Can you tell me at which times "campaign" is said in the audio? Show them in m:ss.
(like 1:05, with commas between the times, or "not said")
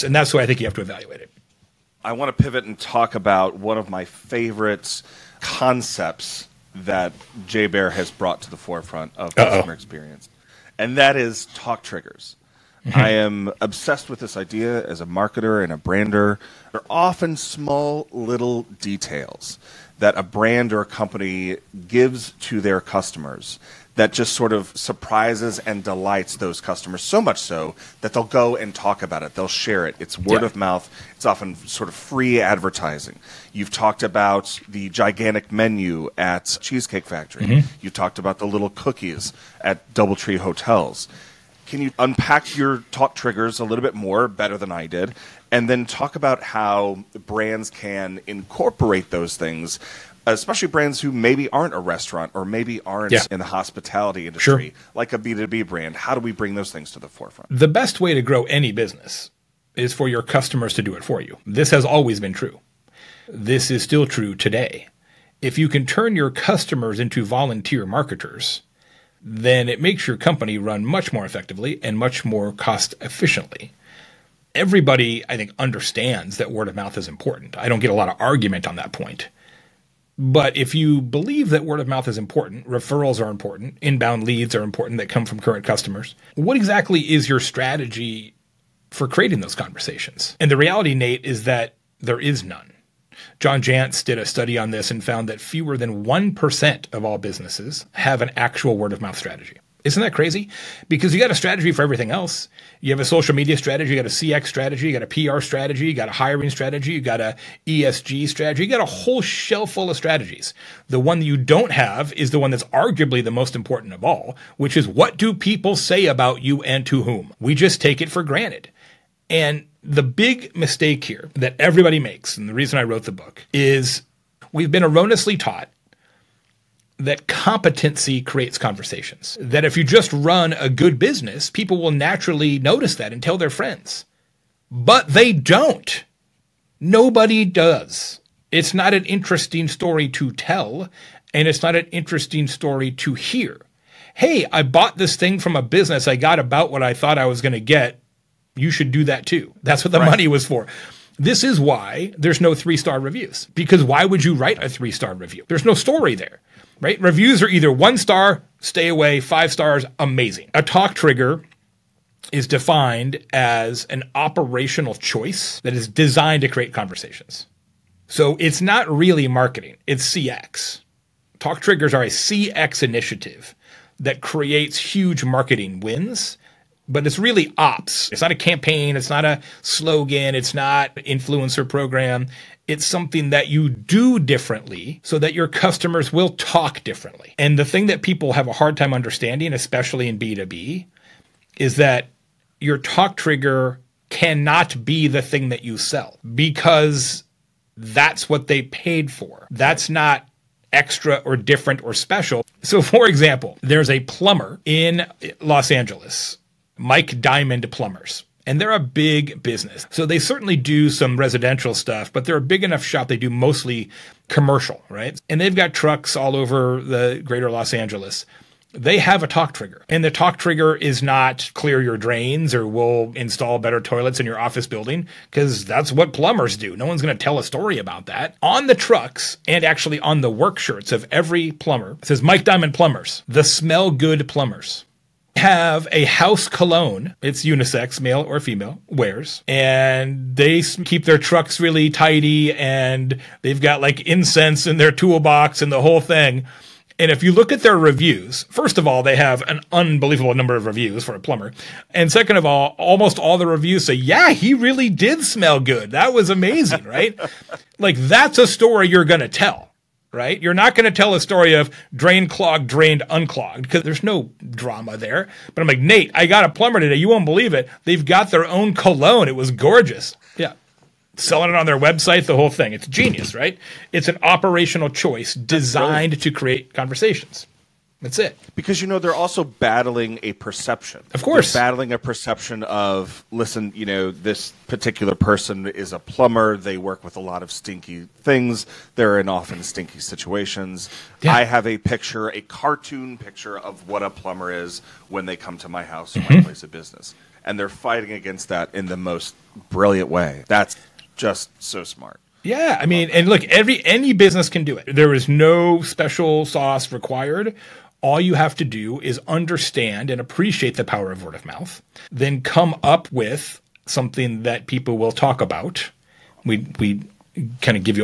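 2:58.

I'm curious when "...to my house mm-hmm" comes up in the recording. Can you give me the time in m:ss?
4:55.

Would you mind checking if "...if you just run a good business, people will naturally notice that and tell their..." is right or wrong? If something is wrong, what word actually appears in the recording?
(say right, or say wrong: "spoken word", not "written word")
right.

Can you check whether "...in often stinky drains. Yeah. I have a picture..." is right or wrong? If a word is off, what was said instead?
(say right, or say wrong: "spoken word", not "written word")
wrong: "situations", not "drains".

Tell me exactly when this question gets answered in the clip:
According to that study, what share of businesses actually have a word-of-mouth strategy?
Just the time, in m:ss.
1:35.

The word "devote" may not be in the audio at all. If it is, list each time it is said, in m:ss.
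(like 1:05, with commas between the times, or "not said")
not said.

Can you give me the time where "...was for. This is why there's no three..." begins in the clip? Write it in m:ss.
2:30.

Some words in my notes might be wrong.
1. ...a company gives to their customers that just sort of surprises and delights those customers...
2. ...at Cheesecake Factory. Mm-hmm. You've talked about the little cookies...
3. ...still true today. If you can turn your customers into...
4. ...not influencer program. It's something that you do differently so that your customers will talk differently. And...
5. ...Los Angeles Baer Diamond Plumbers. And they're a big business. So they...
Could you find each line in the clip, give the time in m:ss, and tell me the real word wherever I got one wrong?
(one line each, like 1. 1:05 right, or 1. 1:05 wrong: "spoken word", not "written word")
1. 0:20 right
2. 0:36 right
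3. 1:03 right
4. 3:00 right
5. 3:25 wrong: "Mike", not "Baer".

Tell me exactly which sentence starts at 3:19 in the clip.
That's not extra or different or special.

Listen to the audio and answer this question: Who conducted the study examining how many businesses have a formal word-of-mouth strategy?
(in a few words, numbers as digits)
John Jantsch.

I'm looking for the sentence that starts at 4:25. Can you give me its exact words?
But I'm like, Nate, I got a plumber today.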